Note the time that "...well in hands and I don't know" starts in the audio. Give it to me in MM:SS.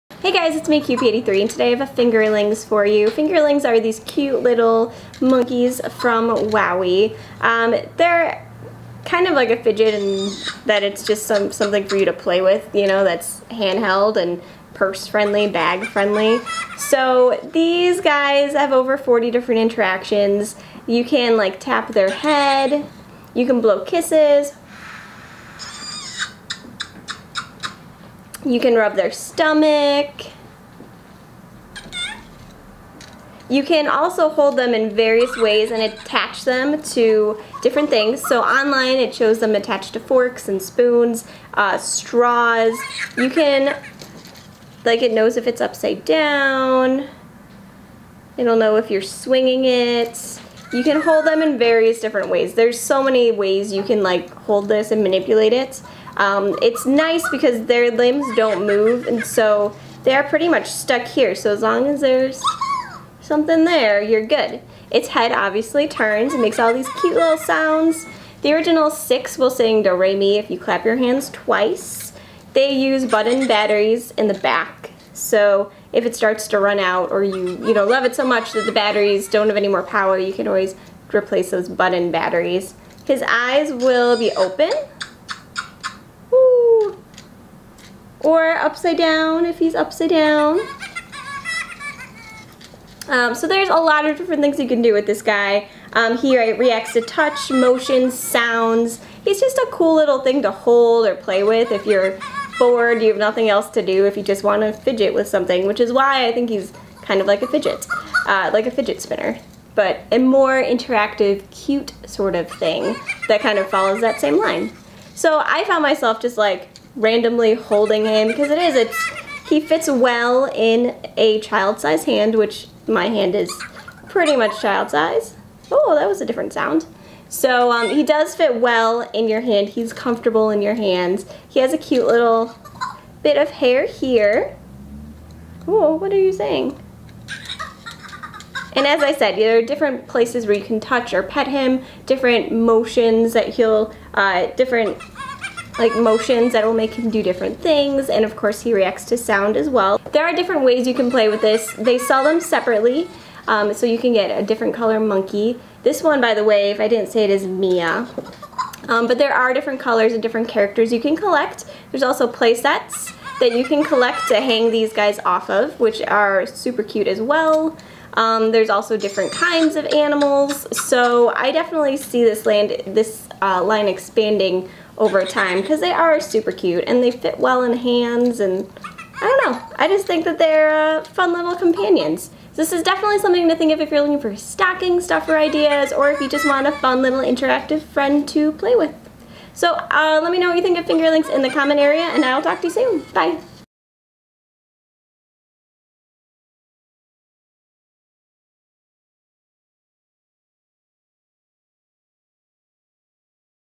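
02:57.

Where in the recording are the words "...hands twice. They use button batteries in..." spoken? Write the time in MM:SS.
01:10.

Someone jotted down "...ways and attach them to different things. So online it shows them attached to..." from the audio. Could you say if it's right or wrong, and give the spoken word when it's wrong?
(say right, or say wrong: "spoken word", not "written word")
right.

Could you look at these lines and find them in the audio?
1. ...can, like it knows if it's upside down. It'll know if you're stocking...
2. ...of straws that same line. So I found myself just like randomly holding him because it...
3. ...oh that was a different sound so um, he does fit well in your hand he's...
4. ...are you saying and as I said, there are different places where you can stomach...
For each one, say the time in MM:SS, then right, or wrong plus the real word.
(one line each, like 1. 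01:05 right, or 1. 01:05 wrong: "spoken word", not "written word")
1. 00:43 wrong: "swinging", not "stocking"
2. 01:53 wrong: "follows", not "straws"
3. 02:05 right
4. 02:16 wrong: "touch", not "stomach".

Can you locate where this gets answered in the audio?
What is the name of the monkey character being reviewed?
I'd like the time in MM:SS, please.
02:37.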